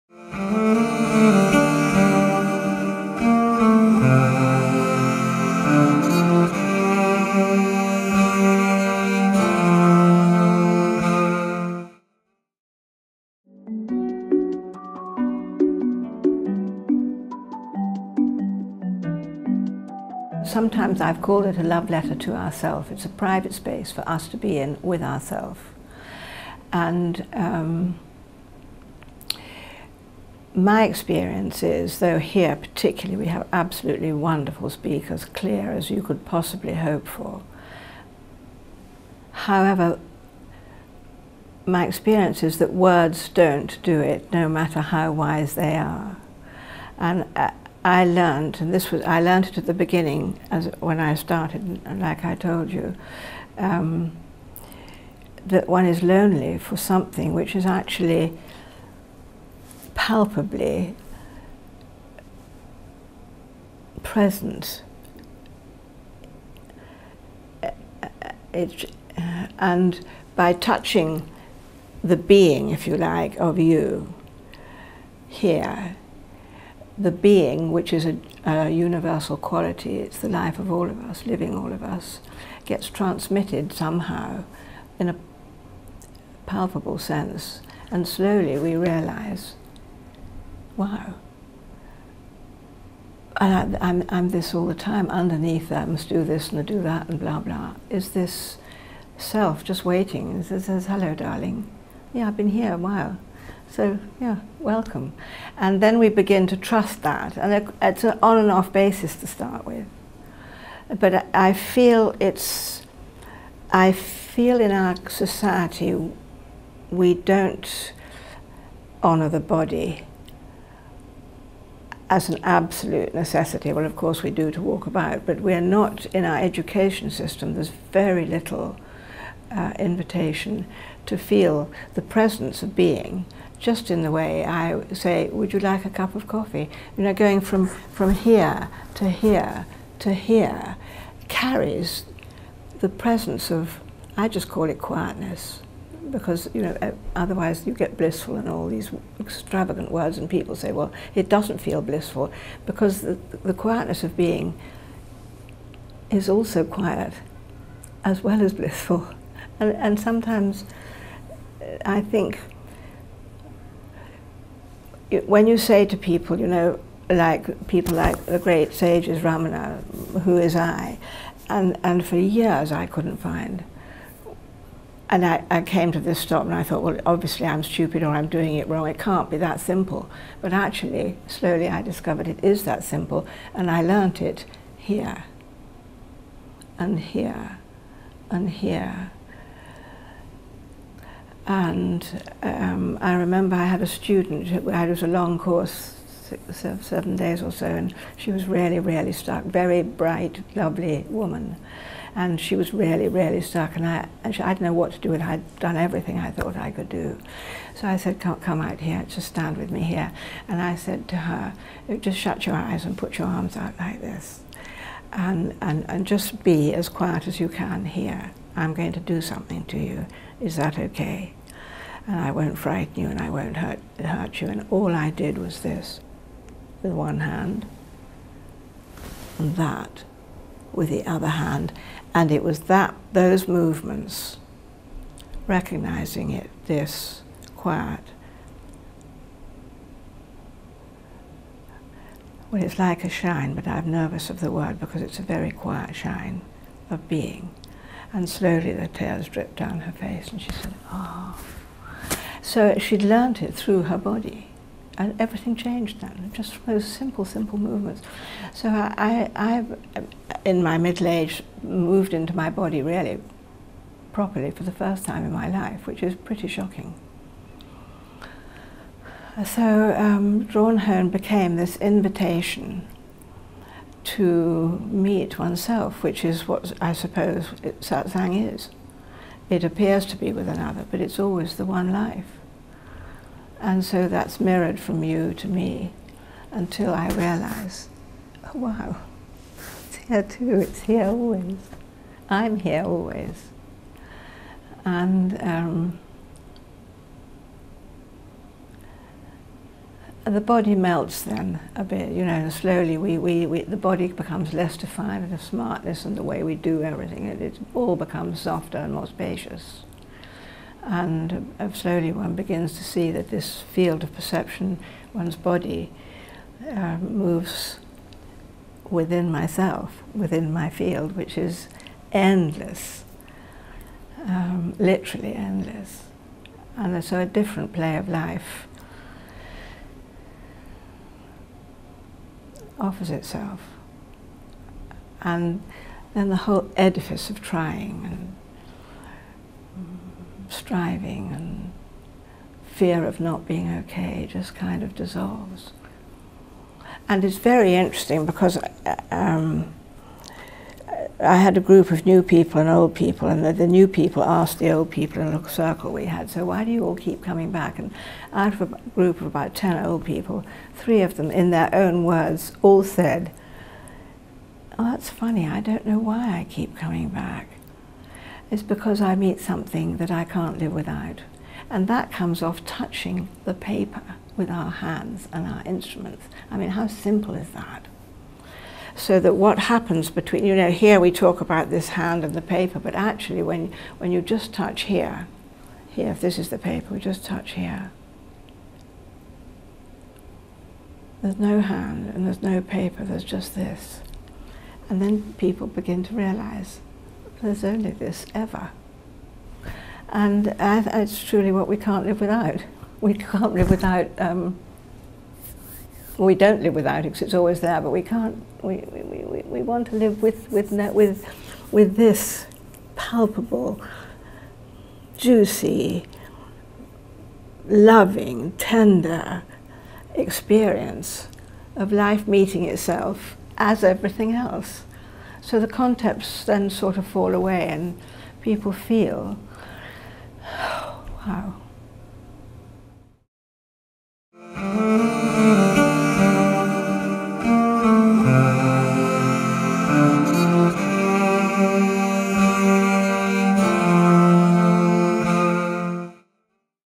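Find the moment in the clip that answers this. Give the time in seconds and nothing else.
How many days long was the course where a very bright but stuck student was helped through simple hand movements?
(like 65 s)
196 s.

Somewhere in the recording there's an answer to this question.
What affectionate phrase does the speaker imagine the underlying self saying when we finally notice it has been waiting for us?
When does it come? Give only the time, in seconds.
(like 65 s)
100 s.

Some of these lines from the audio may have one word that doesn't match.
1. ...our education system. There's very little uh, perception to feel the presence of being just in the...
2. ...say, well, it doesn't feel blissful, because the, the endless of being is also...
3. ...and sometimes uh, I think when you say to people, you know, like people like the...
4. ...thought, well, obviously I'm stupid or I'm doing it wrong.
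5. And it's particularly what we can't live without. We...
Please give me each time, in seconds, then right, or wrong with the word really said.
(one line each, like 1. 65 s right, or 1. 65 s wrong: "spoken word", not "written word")
1. 126 s wrong: "invitation", not "perception"
2. 150 s wrong: "quietness", not "endless"
3. 159 s right
4. 176 s right
5. 400 s wrong: "truly", not "particularly".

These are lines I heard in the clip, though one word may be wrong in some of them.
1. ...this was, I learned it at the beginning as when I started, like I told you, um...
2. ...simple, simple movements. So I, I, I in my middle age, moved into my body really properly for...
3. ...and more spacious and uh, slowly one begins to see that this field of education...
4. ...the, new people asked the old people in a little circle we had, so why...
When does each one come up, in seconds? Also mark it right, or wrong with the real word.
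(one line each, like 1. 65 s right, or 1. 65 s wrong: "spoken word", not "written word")
1. 48 s right
2. 256 s right
3. 308 s wrong: "perception", not "education"
4. 353 s right.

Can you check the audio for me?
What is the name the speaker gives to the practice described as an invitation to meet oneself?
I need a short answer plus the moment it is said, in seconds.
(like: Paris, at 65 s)
Drawn Home, at 270 s.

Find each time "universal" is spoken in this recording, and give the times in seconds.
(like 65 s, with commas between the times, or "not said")
78 s.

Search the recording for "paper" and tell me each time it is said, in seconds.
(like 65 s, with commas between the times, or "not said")
373 s, 382 s, 386 s, 392 s.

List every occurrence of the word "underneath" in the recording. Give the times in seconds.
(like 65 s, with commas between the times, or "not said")
95 s.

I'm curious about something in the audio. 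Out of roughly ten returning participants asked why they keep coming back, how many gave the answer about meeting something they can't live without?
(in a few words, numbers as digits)
3.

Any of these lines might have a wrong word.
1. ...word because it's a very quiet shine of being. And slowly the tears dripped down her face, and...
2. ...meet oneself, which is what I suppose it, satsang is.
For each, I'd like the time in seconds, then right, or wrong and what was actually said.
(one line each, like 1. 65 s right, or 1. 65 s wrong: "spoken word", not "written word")
1. 244 s right
2. 274 s right.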